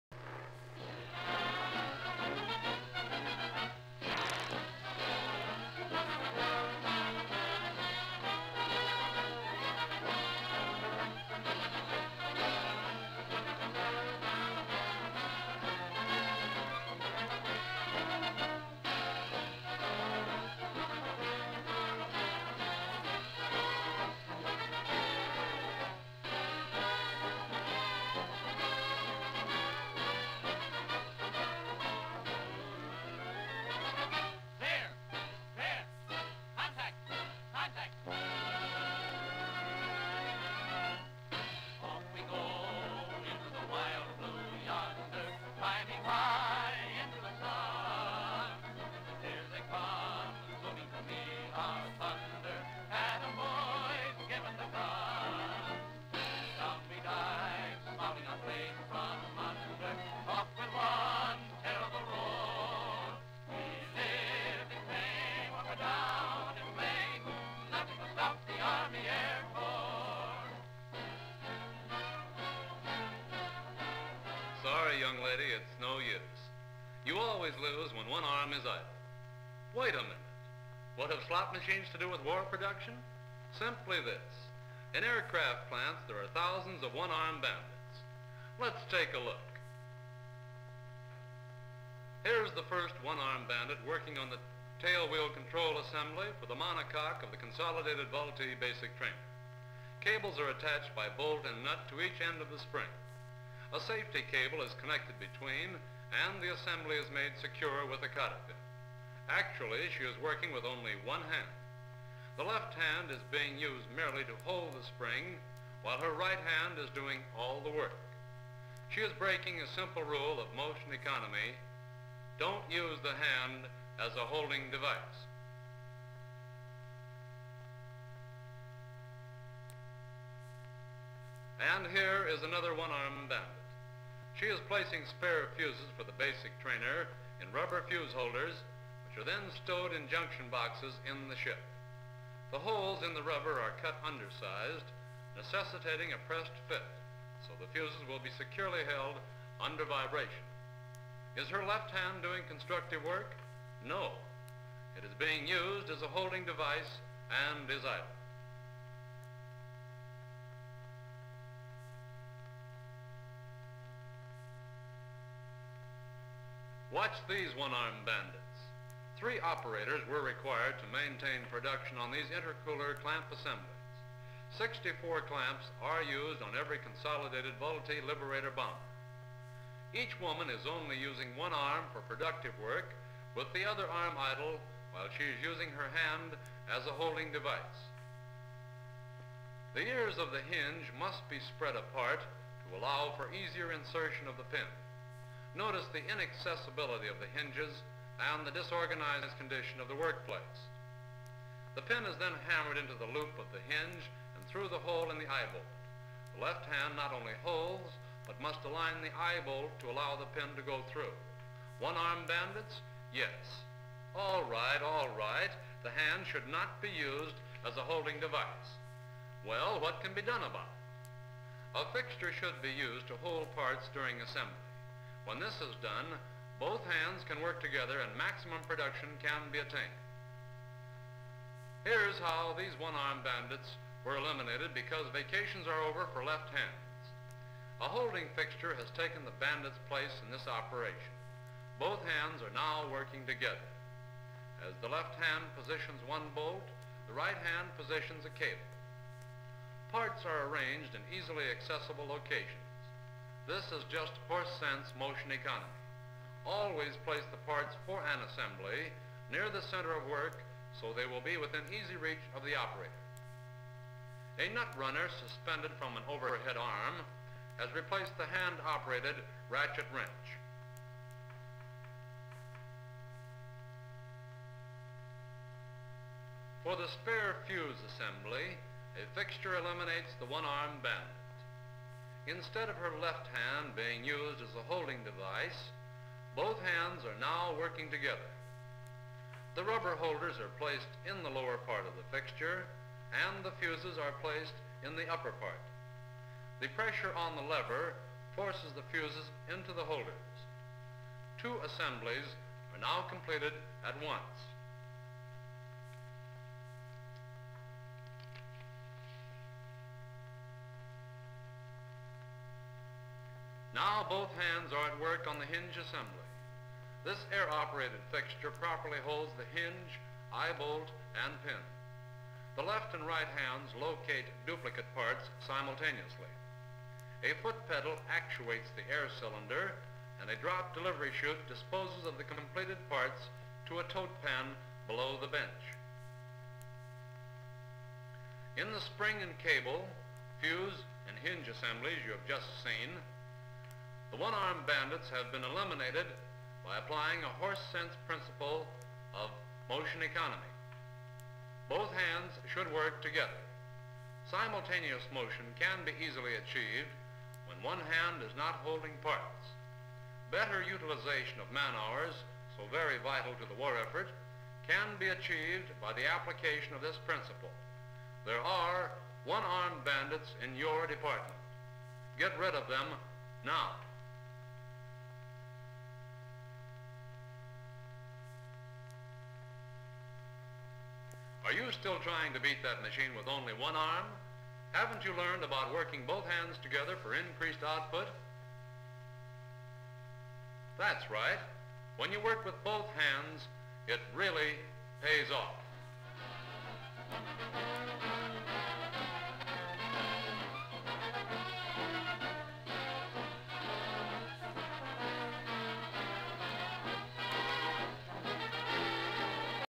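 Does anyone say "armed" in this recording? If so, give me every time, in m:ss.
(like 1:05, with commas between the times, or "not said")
1:26, 1:32, 2:12, 2:47, 3:31, 3:52, 5:44, 6:09.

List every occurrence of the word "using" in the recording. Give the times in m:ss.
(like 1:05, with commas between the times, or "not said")
3:00, 3:05.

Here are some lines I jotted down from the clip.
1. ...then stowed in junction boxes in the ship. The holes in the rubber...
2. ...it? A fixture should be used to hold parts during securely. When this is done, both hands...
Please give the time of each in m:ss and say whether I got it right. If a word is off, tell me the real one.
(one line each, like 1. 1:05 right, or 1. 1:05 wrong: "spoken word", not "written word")
1. 2:19 right
2. 3:40 wrong: "assembly", not "securely".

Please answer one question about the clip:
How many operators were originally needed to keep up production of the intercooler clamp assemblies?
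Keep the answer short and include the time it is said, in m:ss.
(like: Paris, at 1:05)
3, at 2:49.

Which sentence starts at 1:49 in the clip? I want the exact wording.
Actually, she is working with only one hand.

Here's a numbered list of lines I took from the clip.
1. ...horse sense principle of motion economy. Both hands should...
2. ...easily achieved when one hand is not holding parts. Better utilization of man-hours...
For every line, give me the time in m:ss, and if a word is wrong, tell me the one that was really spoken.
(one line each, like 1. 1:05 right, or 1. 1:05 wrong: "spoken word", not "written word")
1. 5:47 right
2. 5:56 right.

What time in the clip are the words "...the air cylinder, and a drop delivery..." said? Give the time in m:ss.
5:28.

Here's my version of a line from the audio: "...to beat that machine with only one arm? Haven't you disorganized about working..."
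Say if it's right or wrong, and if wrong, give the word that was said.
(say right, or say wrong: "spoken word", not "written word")
wrong: "learned", not "disorganized".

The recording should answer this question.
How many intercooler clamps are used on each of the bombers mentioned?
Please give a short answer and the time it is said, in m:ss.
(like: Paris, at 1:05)
64, at 2:54.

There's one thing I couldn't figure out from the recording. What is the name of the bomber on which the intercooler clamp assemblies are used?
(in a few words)
Liberator.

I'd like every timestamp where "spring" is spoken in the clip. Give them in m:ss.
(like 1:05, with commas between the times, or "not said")
1:42, 1:54, 5:38.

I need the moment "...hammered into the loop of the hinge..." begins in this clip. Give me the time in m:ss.
3:22.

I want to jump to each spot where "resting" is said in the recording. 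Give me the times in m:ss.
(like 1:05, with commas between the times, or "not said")
not said.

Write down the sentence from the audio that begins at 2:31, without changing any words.
Is her left hand doing constructive work?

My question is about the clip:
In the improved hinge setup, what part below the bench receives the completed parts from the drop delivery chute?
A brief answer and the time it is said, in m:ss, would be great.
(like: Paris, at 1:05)
Tote pan, at 5:33.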